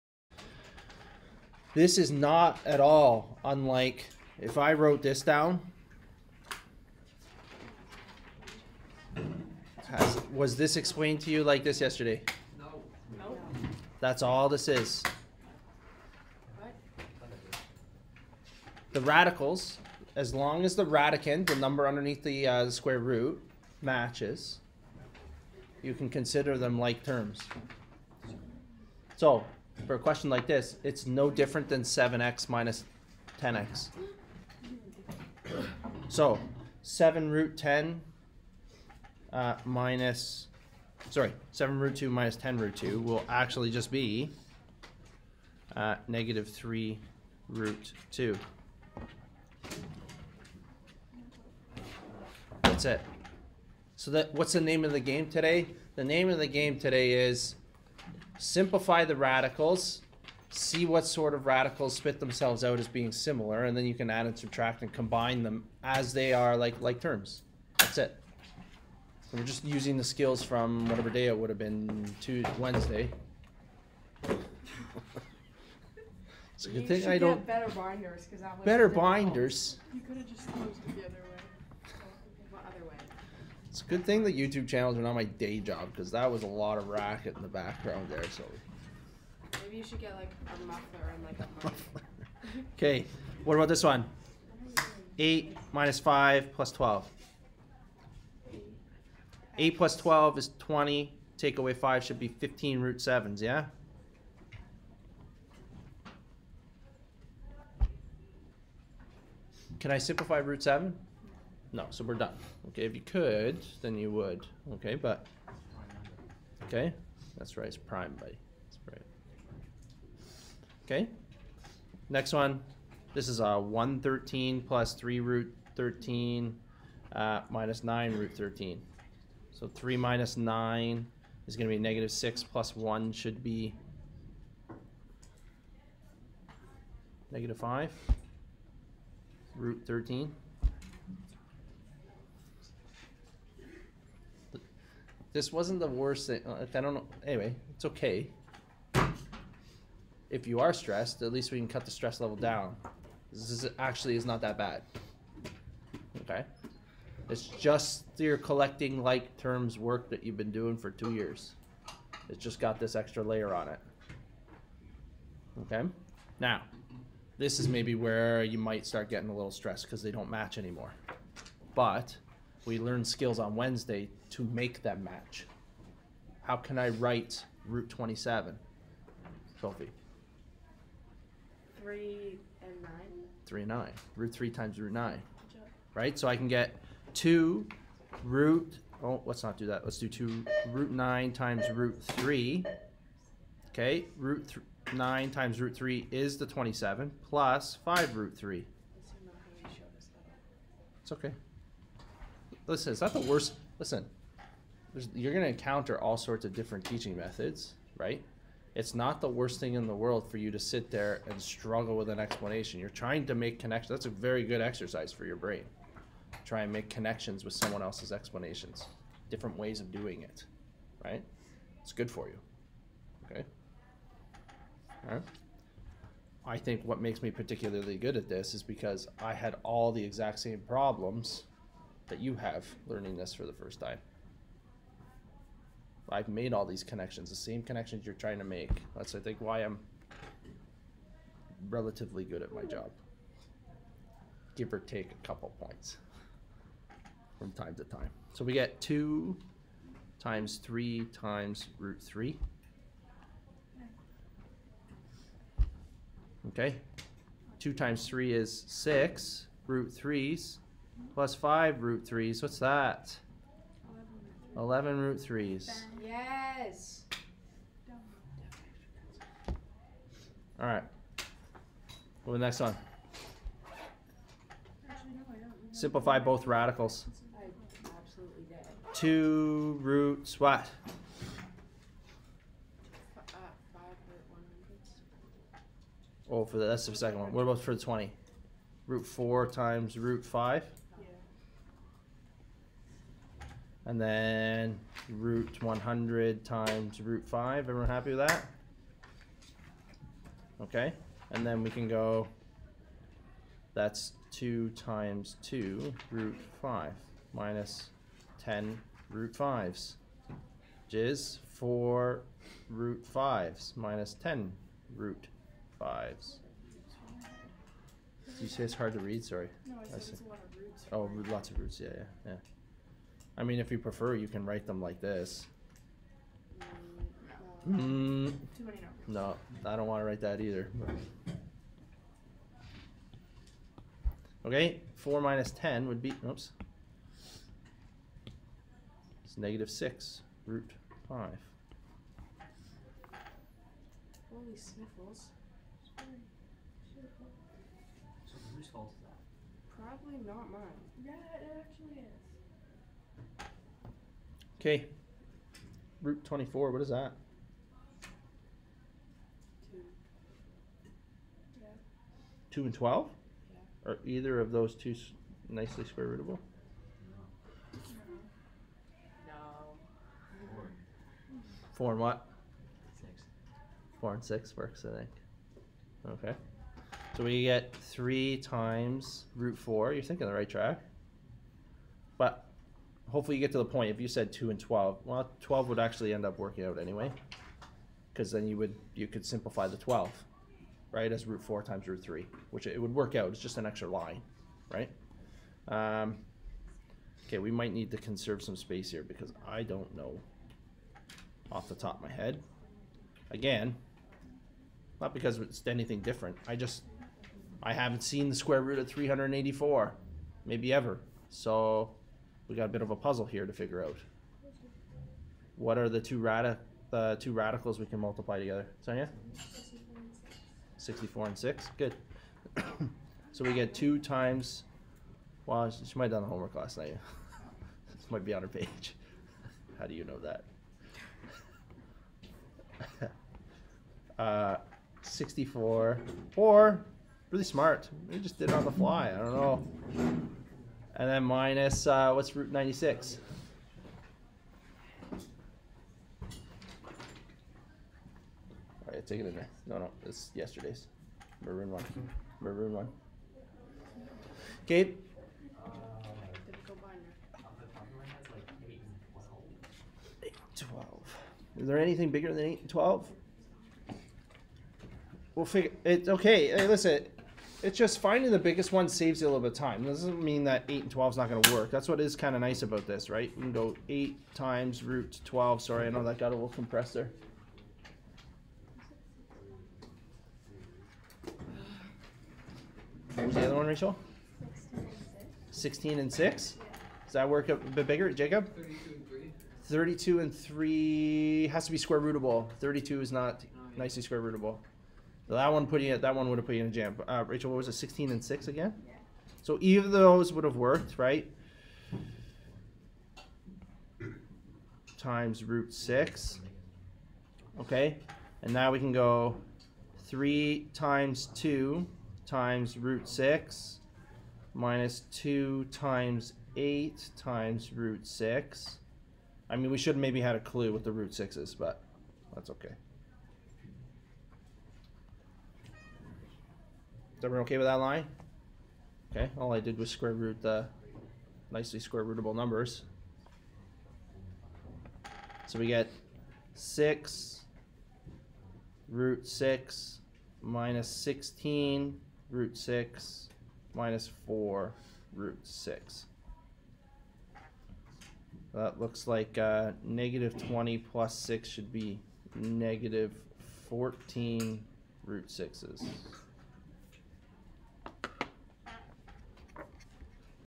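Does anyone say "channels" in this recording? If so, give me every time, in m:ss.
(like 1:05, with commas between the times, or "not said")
1:24.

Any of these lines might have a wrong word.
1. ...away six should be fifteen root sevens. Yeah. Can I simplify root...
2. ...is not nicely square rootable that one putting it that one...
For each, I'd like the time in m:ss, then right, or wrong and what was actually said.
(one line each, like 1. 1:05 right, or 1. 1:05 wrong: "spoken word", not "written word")
1. 1:41 wrong: "five", not "six"
2. 8:13 right.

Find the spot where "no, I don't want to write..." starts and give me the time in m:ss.
5:29.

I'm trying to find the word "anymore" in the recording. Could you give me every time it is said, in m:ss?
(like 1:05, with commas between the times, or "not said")
2:50.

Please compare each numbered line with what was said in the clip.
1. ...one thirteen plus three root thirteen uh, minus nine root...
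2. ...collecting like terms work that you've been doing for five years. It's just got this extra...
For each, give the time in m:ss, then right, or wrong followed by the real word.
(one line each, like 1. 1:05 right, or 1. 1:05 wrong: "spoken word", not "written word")
1. 2:03 right
2. 2:38 wrong: "two", not "five".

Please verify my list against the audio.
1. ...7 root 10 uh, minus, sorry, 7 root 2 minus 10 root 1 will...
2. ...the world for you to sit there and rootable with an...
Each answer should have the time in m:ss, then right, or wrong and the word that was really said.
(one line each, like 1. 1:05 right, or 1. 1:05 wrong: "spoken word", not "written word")
1. 0:36 wrong: "2", not "1"
2. 3:29 wrong: "struggle", not "rootable".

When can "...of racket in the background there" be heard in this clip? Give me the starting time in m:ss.
1:26.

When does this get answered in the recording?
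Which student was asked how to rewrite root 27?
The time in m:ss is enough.
2:59.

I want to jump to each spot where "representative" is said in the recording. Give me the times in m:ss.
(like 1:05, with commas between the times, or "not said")
not said.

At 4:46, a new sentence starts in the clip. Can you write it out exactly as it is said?
Oh, for the, that's the second one.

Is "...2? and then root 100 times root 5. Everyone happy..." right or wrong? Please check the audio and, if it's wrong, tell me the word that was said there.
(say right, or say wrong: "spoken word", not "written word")
wrong: "5", not "2".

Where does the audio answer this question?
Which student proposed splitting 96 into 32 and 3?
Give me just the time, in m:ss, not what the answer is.
8:08.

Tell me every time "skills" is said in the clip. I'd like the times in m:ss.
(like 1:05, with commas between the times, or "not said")
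1:10, 2:53.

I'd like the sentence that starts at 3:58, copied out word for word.
That's, I think, why I'm relatively good at my job.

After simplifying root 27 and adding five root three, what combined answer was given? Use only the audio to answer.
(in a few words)
11 root 3.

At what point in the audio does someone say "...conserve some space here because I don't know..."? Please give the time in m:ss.
6:37.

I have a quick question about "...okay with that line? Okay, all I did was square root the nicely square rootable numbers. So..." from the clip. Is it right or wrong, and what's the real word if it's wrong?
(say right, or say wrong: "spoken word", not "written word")
right.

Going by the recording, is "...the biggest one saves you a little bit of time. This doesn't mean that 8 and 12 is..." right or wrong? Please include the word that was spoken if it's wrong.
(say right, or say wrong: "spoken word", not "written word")
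right.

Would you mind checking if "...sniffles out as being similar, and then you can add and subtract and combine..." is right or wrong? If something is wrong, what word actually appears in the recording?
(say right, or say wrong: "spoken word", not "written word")
wrong: "themselves", not "sniffles".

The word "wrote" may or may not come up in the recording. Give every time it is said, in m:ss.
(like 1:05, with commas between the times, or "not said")
0:04.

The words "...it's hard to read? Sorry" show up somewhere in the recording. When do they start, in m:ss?
5:18.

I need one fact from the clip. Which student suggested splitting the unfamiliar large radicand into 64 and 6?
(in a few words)
Sonia.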